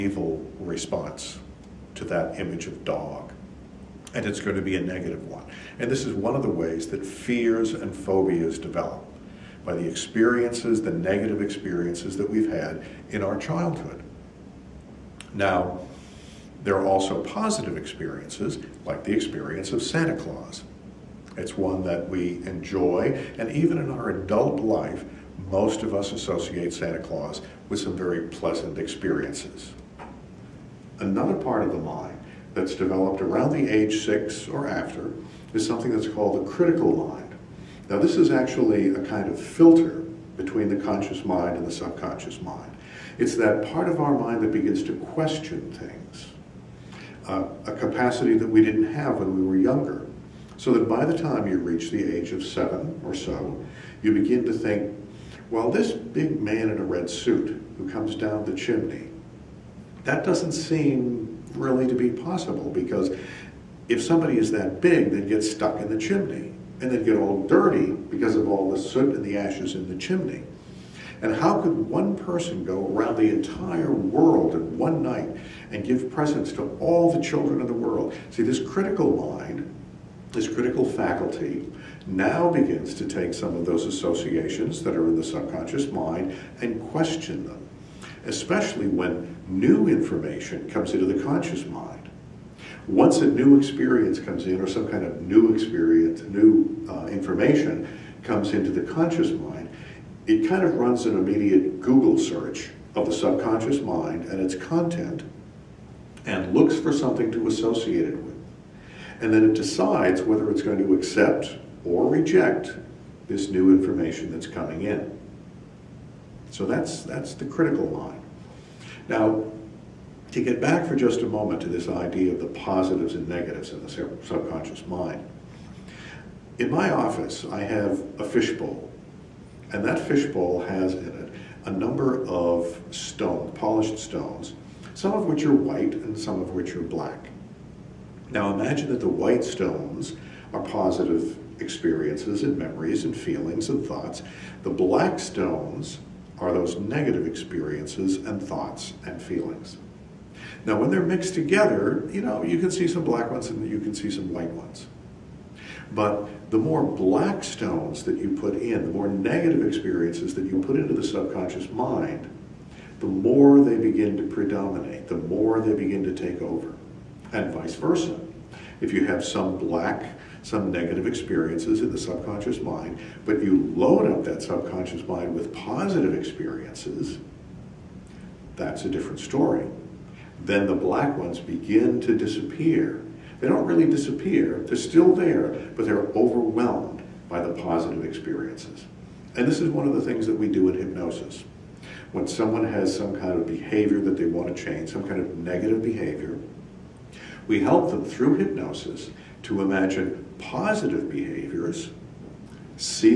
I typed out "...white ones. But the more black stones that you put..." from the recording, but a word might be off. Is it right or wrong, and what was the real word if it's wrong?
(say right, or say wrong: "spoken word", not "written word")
right.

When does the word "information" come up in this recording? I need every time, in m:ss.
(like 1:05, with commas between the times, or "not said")
1:29, 1:37, 1:53.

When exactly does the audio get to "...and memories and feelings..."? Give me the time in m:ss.
2:22.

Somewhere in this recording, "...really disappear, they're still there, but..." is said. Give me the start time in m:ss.
3:03.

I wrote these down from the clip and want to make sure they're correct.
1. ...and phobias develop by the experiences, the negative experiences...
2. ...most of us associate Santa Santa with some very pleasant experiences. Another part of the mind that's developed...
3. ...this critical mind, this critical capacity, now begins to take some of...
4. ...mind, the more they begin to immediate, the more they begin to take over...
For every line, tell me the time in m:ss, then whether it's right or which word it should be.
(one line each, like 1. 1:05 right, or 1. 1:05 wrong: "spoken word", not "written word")
1. 0:07 right
2. 0:25 wrong: "Claus", not "Santa"
3. 1:18 wrong: "faculty", not "capacity"
4. 2:41 wrong: "predominate", not "immediate".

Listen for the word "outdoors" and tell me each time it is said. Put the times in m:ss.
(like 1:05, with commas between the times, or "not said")
not said.